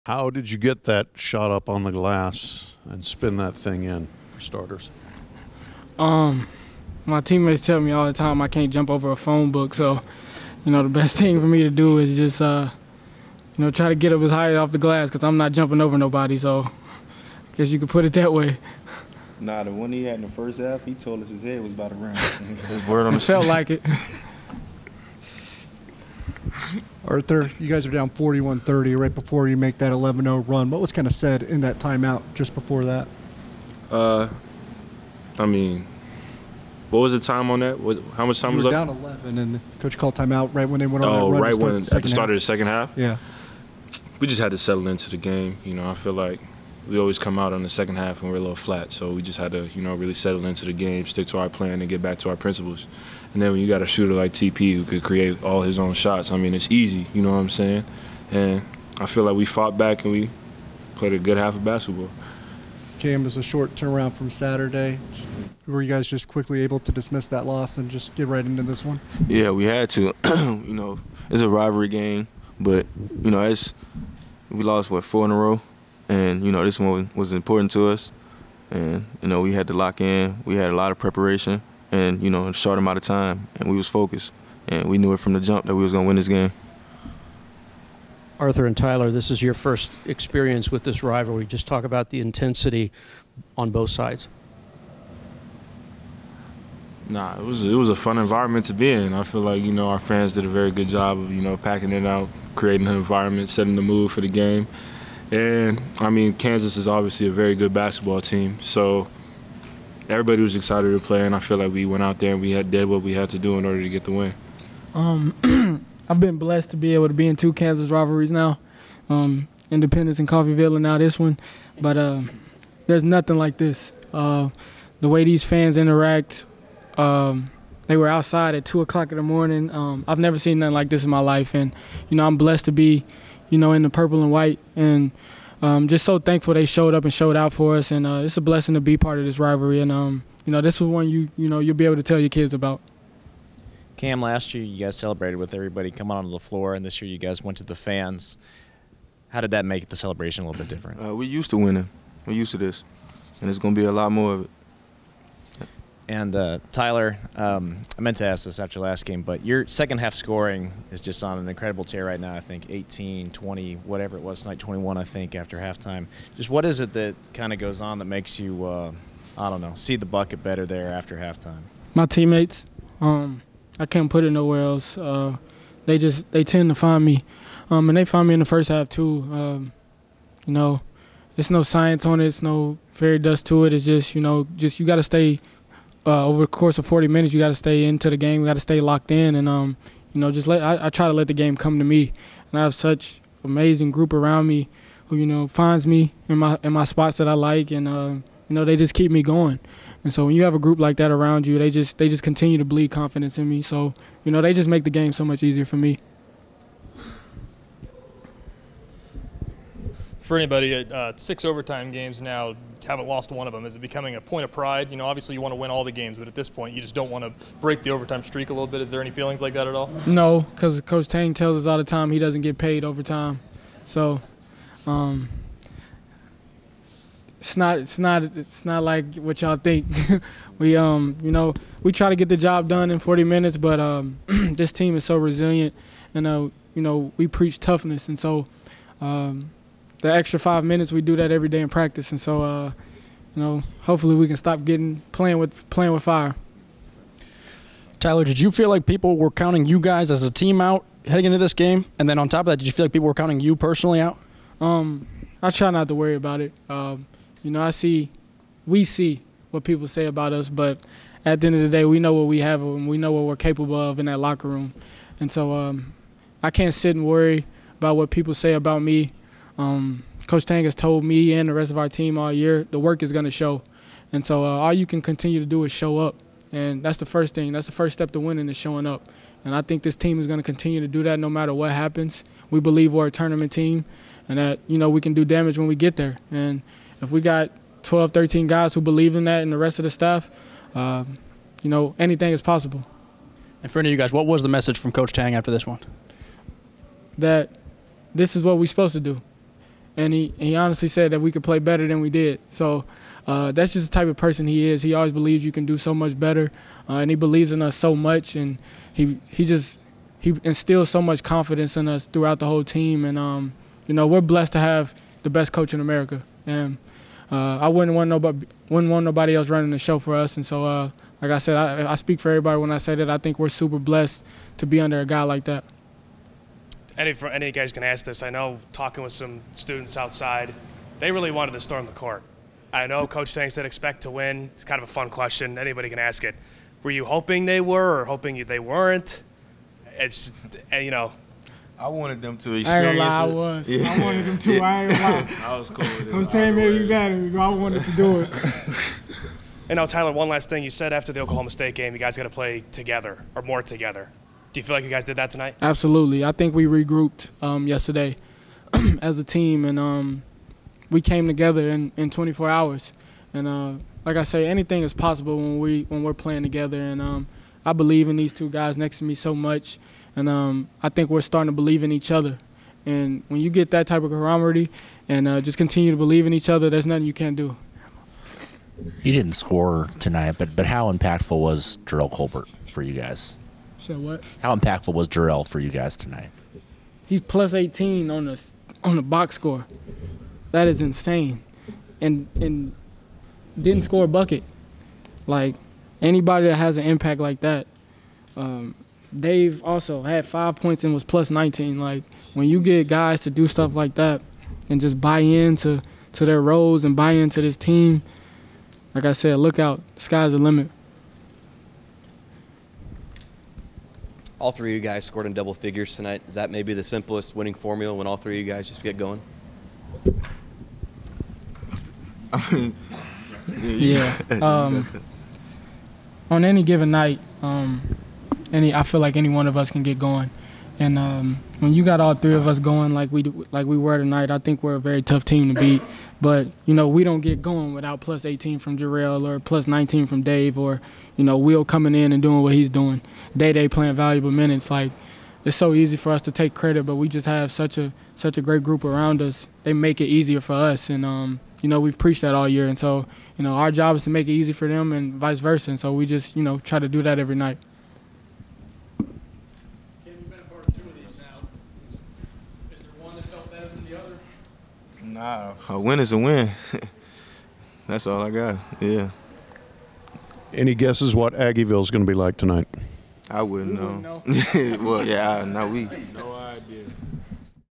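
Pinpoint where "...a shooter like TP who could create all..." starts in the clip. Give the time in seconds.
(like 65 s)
53 s.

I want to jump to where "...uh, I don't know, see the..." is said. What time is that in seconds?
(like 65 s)
168 s.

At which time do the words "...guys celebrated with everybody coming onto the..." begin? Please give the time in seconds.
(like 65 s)
144 s.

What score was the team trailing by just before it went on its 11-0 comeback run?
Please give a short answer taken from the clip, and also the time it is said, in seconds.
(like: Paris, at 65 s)
41-30, at 28 s.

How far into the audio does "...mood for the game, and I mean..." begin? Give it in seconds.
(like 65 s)
103 s.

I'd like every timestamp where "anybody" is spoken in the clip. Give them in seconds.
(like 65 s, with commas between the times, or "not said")
210 s, 335 s, 396 s.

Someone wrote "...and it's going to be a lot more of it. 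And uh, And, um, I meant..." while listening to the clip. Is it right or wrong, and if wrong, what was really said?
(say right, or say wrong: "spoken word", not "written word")
wrong: "Tylor", not "And".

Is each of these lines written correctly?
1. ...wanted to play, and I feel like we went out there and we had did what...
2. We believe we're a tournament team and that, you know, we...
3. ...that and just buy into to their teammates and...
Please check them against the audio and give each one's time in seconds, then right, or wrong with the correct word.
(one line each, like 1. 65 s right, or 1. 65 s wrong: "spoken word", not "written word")
1. 110 s wrong: "excited", not "wanted"
2. 282 s right
3. 403 s wrong: "roles", not "teammates".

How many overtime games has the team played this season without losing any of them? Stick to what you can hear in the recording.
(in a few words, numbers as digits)
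6.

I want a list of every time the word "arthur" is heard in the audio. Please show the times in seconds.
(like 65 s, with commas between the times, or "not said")
27 s, 88 s.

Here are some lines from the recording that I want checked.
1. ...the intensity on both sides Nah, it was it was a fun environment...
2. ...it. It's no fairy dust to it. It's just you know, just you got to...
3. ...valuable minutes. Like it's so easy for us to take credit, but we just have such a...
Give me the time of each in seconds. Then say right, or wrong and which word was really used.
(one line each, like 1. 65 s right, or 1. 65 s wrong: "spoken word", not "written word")
1. 92 s right
2. 182 s right
3. 443 s right.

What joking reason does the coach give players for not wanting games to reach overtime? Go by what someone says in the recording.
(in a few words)
He doesn't get paid overtime.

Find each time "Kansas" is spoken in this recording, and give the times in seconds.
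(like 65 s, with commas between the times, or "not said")
106 s, 117 s.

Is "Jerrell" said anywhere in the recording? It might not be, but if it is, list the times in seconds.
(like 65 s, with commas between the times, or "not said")
385 s, 438 s.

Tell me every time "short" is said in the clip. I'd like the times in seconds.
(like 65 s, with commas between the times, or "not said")
63 s, 82 s.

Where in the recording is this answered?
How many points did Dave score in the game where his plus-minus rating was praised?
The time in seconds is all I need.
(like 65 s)
400 s.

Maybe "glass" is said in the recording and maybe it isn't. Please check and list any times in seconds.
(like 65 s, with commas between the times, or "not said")
1 s, 14 s.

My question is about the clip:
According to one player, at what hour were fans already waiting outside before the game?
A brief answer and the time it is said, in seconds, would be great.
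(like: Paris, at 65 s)
2 a.m., at 128 s.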